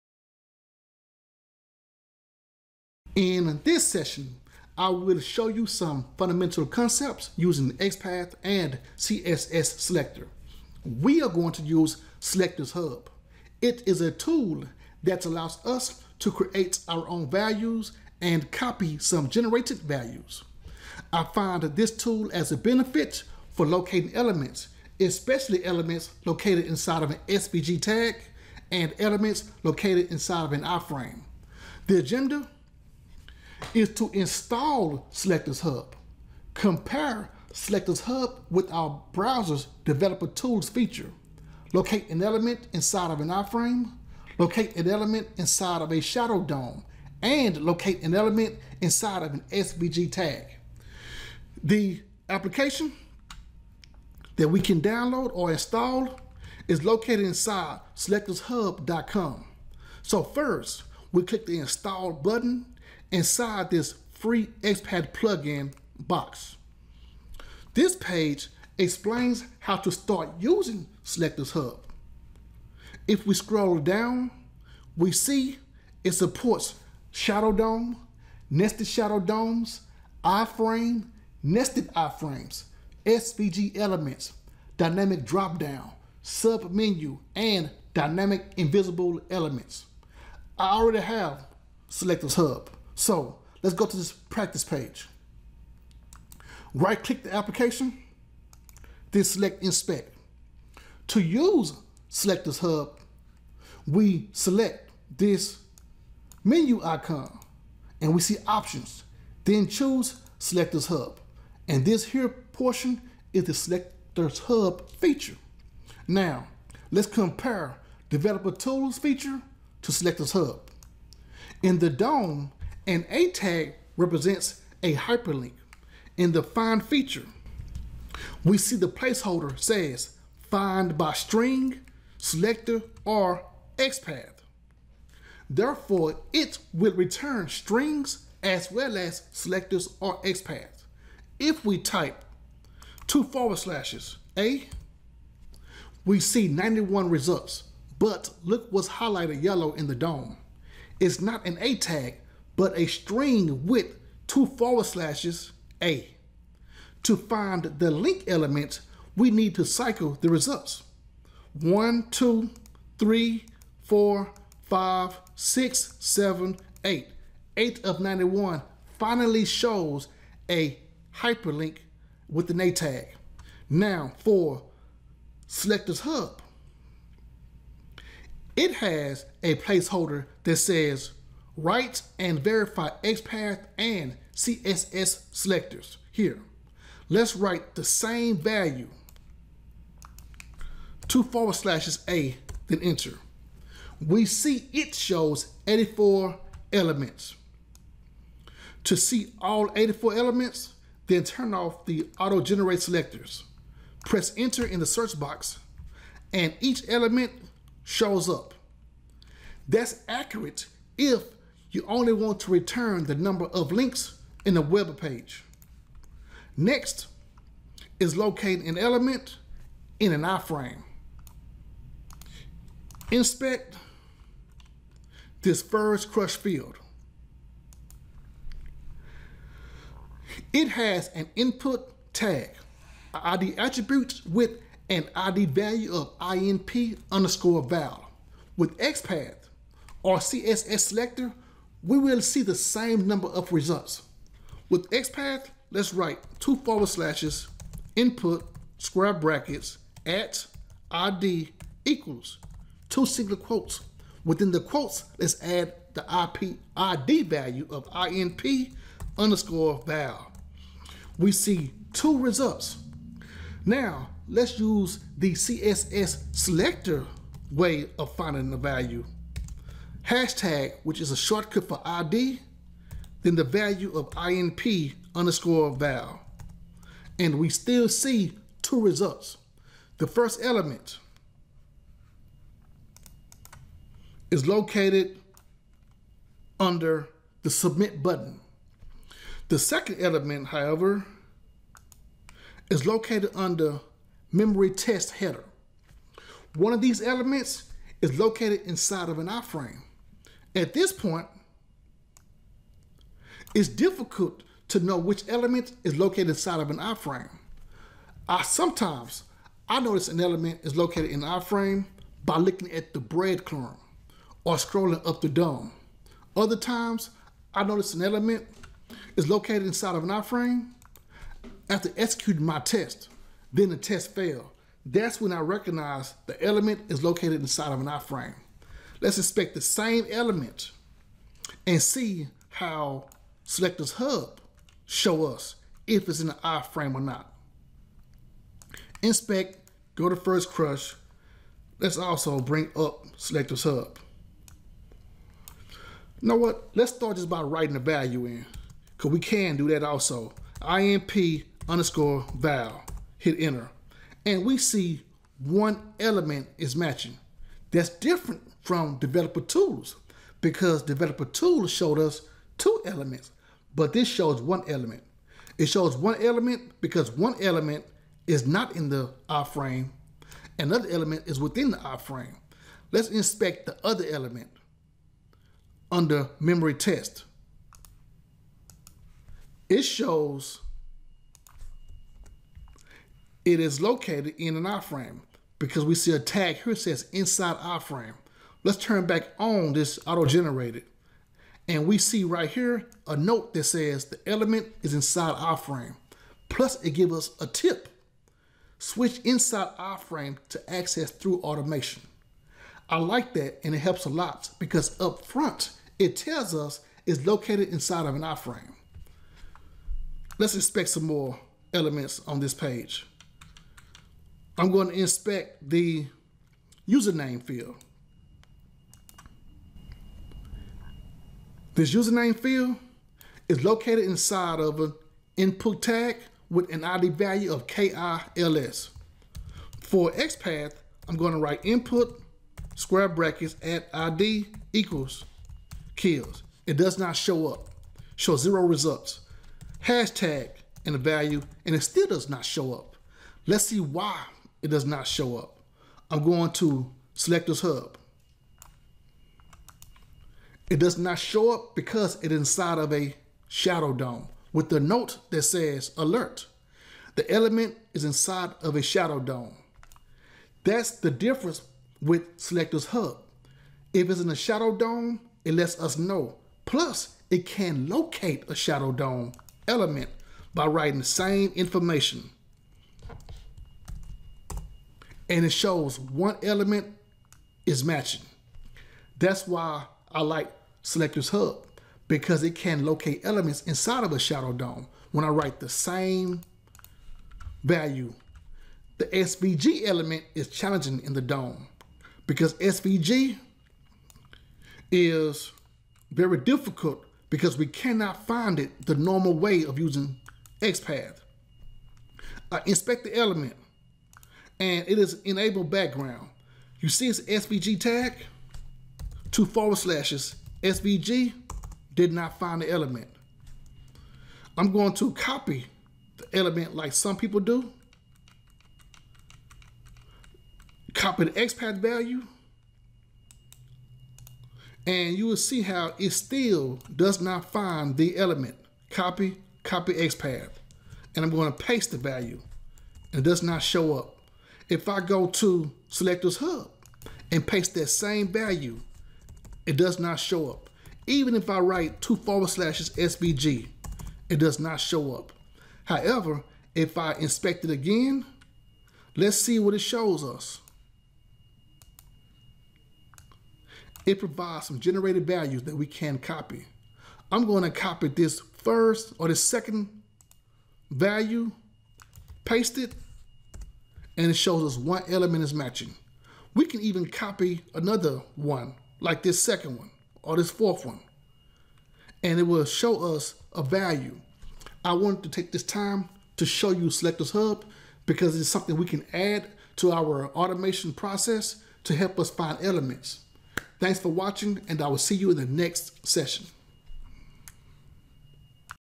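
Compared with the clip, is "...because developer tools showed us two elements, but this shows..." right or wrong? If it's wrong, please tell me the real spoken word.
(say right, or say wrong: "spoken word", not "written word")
right.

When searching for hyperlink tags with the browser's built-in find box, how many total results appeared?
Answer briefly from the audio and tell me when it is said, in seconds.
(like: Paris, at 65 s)
91, at 146 s.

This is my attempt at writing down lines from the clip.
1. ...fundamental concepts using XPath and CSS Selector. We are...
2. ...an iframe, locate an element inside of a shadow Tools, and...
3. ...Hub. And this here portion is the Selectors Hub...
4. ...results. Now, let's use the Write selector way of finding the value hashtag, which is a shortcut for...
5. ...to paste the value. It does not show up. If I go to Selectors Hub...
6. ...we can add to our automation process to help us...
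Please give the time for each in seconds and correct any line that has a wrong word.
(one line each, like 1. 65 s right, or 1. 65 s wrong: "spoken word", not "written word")
1. 6 s right
2. 43 s wrong: "DOM", not "Tools"
3. 110 s right
4. 262 s wrong: "CSS", not "Write"
5. 531 s right
6. 578 s right.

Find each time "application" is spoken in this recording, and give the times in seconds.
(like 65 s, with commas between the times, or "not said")
52 s, 97 s.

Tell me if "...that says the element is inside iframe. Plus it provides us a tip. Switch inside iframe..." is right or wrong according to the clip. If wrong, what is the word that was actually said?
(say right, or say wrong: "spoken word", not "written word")
wrong: "gives", not "provides".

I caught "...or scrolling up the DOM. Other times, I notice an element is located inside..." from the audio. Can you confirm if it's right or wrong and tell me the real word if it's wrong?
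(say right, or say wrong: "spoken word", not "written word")
right.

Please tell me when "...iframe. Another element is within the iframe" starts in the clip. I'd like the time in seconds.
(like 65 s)
369 s.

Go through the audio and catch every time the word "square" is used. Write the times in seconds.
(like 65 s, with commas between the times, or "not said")
248 s, 432 s.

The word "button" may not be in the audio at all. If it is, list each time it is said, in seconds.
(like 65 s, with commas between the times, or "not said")
62 s, 288 s.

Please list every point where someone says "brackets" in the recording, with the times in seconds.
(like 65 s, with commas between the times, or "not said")
249 s, 433 s.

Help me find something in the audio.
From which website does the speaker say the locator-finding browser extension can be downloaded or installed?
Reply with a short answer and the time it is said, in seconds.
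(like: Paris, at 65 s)
selectorshub.com, at 57 s.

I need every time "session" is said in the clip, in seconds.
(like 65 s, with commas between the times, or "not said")
3 s, 586 s.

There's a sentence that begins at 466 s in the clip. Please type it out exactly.
Plus, it can locate a shadow DOM element by writing the same information.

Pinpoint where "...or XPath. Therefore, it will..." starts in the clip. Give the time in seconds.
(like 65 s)
133 s.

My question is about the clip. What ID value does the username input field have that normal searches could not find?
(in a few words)
KILS.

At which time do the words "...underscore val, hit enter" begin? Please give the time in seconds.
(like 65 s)
351 s.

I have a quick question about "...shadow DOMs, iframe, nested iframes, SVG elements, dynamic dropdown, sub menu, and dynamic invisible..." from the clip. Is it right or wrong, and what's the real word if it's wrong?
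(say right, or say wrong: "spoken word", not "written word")
right.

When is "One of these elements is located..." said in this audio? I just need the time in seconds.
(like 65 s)
296 s.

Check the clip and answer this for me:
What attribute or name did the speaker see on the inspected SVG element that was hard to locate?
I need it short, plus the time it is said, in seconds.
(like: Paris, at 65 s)
enable background, at 505 s.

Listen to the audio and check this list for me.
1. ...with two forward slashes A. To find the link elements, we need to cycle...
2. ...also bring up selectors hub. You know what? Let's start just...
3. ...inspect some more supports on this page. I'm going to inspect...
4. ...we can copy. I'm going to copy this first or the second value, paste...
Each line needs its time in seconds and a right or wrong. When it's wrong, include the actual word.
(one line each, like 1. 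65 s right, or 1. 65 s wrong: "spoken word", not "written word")
1. 153 s right
2. 341 s right
3. 410 s wrong: "elements", not "supports"
4. 555 s right.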